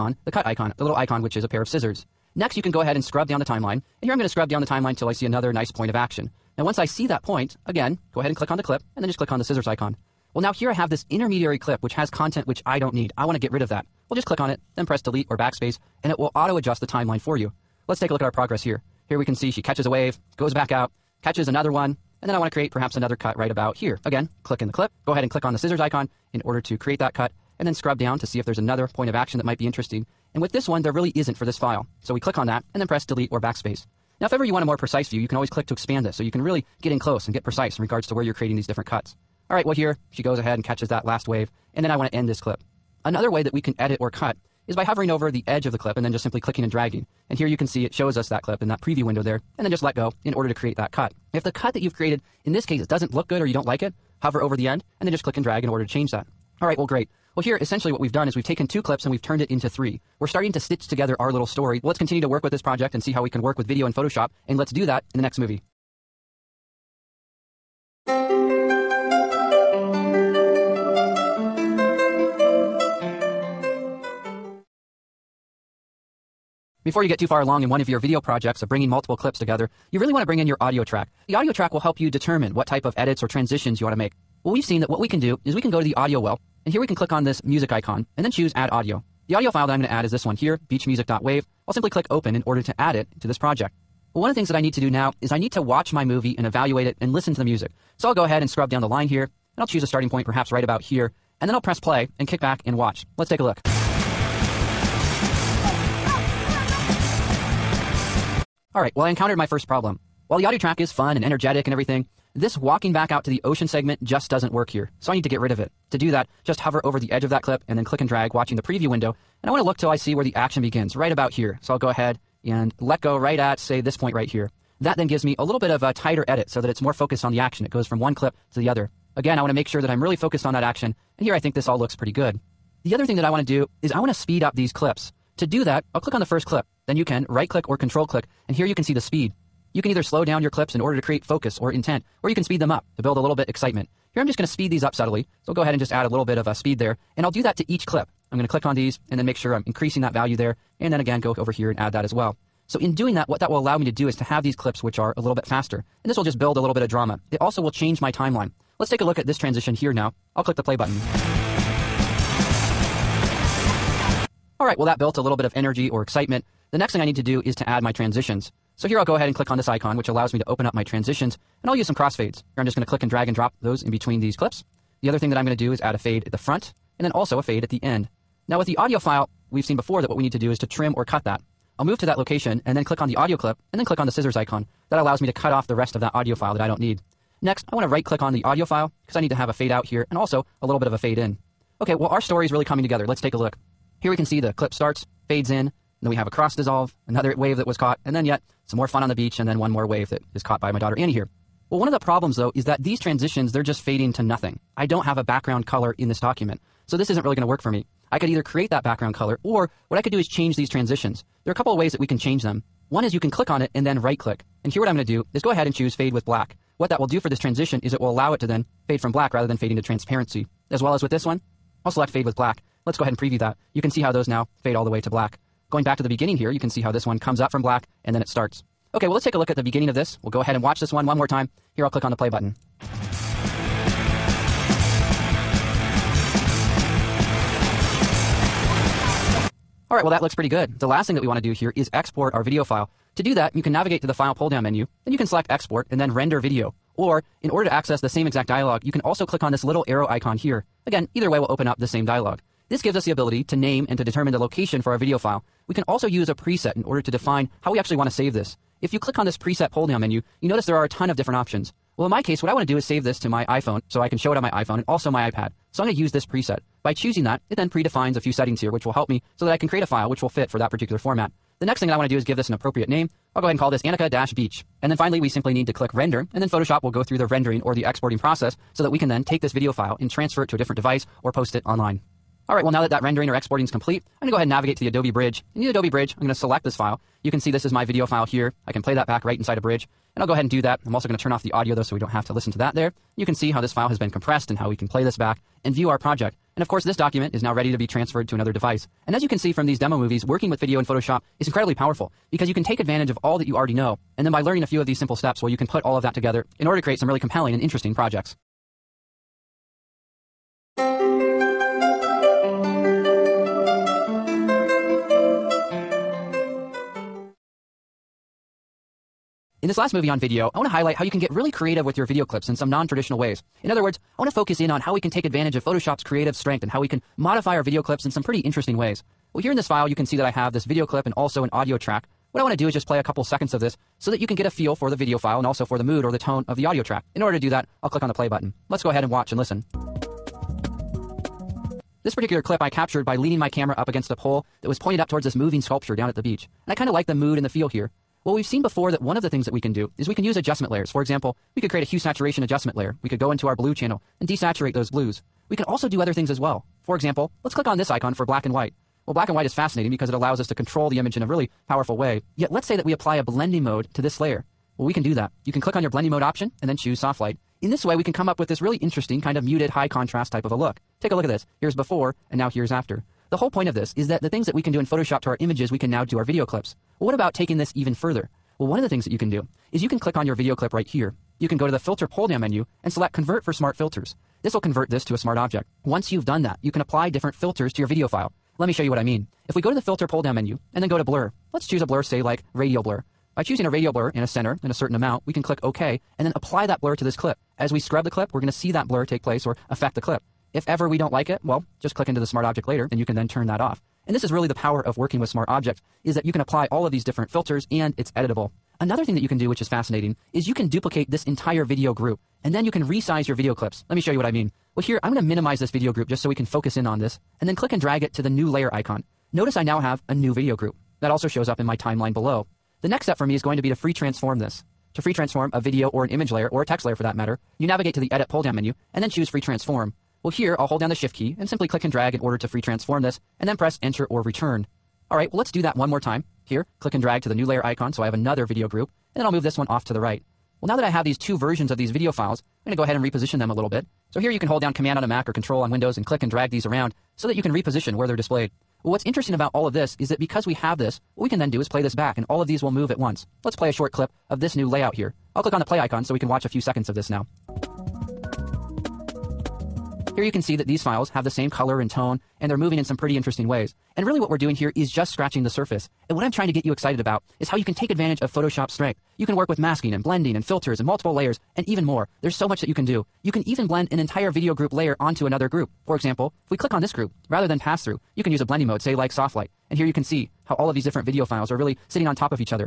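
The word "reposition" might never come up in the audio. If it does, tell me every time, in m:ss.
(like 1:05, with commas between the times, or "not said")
7:23, 7:27.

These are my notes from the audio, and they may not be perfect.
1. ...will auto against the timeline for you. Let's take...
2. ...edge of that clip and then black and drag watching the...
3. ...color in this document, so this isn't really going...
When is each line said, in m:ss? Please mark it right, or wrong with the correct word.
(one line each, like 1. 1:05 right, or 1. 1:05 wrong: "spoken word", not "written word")
1. 0:16 wrong: "adjust", not "against"
2. 1:57 wrong: "click", not "black"
3. 3:25 right.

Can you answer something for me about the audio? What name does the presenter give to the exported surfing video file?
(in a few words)
Annika-Beach.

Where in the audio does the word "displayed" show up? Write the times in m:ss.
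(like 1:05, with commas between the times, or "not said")
7:28.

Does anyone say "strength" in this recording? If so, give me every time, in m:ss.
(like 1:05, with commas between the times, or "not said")
5:26, 7:48.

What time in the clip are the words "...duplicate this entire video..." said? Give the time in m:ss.
6:50.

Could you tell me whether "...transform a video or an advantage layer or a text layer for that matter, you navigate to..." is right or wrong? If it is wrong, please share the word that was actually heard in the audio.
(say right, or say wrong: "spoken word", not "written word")
wrong: "image", not "advantage".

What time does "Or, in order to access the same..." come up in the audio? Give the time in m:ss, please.
4:06.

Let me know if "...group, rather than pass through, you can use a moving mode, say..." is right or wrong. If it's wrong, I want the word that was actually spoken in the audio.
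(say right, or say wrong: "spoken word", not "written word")
wrong: "blending", not "moving".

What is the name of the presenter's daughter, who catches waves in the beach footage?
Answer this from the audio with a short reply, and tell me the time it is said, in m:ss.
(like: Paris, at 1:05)
Annie, at 3:20.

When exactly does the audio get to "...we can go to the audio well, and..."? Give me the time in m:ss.
1:25.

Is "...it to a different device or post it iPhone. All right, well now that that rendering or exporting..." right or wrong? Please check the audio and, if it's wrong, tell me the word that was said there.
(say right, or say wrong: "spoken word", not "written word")
wrong: "online", not "iPhone".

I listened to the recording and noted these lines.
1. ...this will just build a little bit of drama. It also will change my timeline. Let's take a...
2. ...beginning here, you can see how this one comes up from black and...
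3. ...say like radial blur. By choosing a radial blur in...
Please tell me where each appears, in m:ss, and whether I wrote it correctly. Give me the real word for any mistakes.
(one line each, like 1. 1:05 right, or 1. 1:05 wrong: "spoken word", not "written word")
1. 2:36 right
2. 3:46 right
3. 6:32 right.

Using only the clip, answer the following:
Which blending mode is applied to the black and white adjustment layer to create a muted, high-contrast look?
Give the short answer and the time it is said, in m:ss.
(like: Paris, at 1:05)
soft light, at 6:06.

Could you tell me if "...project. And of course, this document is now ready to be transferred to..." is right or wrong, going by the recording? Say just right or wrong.
right.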